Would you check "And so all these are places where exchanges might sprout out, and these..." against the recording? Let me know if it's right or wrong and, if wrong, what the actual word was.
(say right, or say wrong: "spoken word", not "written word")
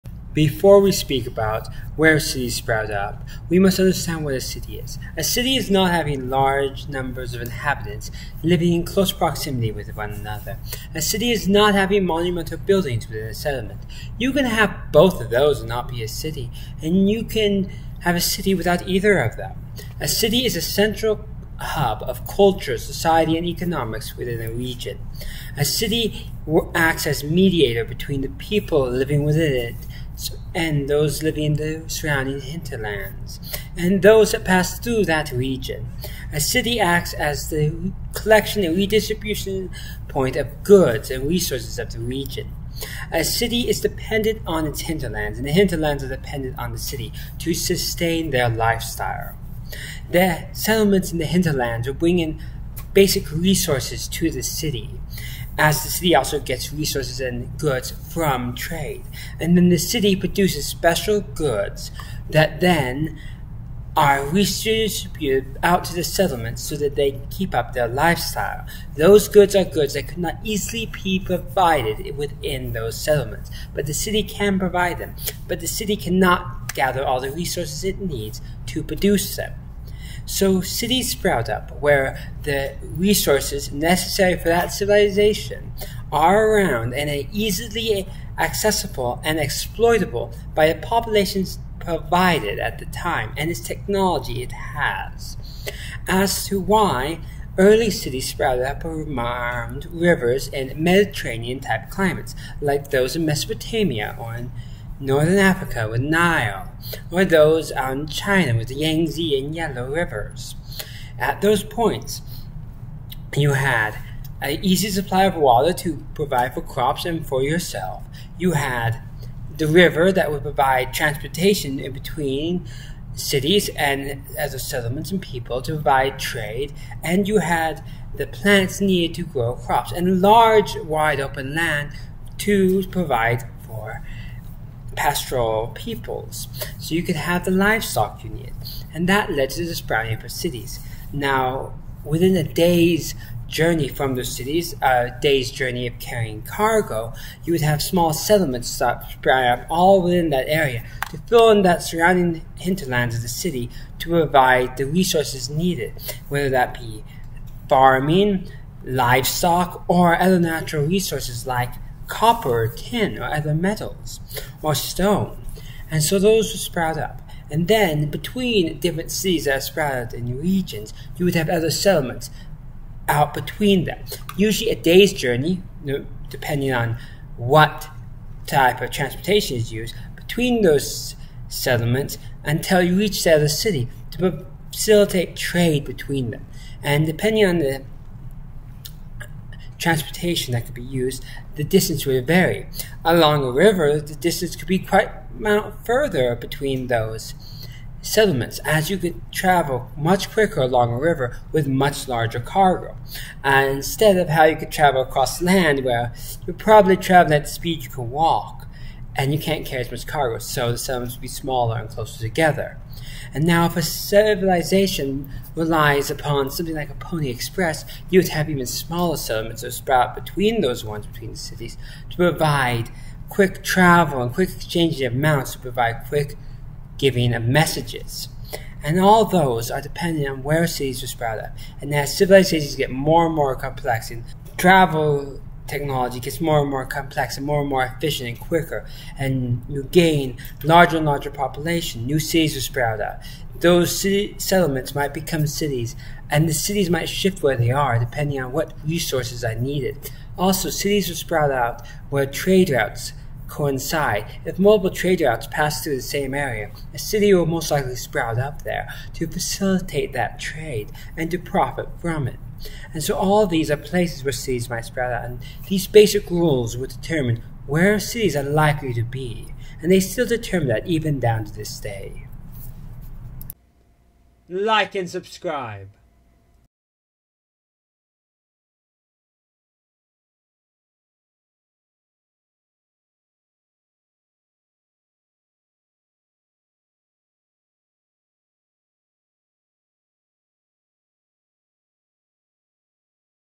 wrong: "cities", not "exchanges".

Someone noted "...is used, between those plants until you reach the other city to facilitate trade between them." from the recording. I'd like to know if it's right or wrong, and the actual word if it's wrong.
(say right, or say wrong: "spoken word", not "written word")
wrong: "settlements", not "plants".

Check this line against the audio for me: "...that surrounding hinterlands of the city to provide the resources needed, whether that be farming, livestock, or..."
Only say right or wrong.
right.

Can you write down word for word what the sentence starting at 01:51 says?
At those points, you had an easy supply of water to provide for crops and for yourself.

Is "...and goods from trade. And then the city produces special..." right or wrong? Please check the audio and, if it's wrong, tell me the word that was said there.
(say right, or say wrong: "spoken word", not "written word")
right.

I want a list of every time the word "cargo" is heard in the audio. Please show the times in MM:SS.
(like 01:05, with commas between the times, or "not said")
02:26, 03:22, 03:30.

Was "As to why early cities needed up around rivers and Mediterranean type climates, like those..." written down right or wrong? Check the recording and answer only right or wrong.
wrong.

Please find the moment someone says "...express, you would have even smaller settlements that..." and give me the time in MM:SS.
03:37.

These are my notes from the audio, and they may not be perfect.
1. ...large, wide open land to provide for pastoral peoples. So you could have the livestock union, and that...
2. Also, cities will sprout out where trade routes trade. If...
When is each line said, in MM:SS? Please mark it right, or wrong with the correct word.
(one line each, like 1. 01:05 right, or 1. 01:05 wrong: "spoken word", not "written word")
1. 02:10 right
2. 04:10 wrong: "coincide", not "trade".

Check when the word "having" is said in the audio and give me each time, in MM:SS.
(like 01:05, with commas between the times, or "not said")
00:05, 00:11.